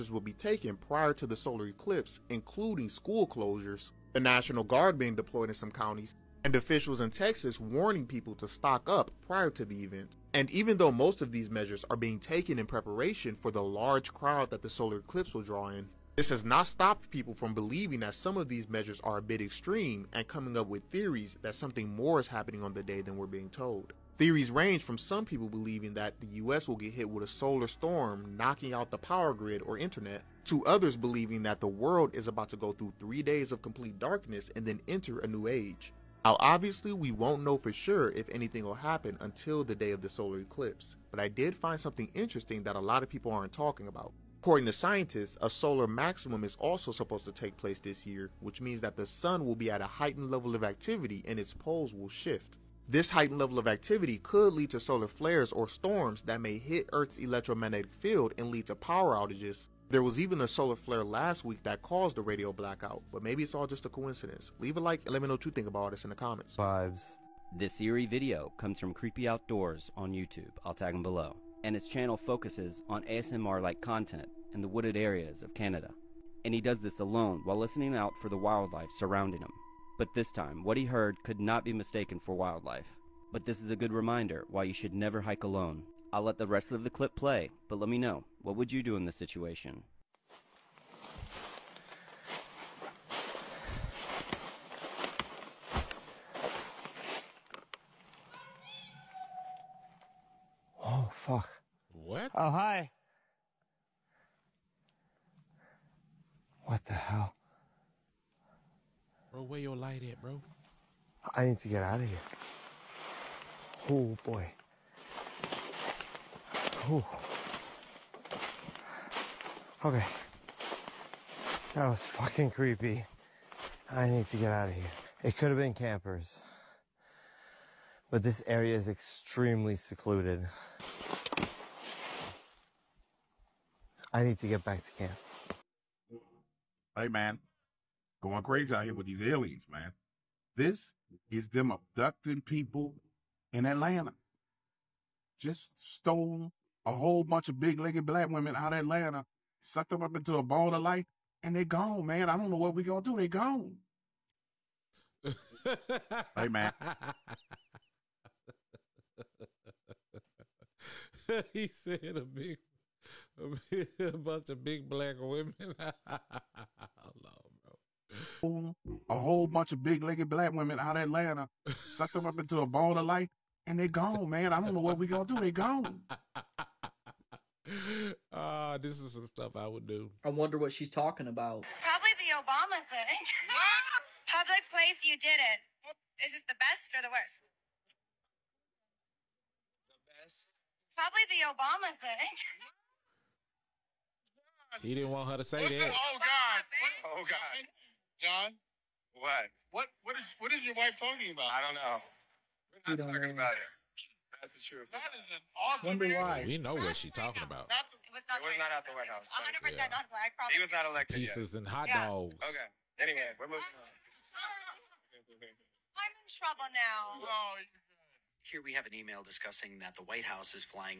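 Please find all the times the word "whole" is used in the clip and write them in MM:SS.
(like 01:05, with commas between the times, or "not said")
02:26, 02:49.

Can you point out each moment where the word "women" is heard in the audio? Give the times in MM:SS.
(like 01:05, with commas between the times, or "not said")
02:28, 02:45, 02:50.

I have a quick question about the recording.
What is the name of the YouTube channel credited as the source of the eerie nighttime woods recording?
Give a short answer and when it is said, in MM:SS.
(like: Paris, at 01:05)
Creepy Outdoors, at 01:08.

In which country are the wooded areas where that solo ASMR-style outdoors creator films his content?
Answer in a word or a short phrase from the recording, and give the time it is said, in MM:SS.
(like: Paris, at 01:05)
Canada, at 01:15.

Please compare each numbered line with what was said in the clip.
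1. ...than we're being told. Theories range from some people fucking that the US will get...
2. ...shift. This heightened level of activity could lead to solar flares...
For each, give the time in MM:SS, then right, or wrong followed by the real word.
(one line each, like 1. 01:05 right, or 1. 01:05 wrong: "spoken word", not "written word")
1. 00:23 wrong: "believing", not "fucking"
2. 00:52 right.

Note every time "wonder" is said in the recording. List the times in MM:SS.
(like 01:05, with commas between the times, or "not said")
03:00, 03:25.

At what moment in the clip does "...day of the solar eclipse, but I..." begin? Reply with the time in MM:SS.
00:39.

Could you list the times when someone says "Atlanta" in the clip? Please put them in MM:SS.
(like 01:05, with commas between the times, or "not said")
02:23, 02:28, 02:51.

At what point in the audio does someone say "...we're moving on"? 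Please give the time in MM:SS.
03:33.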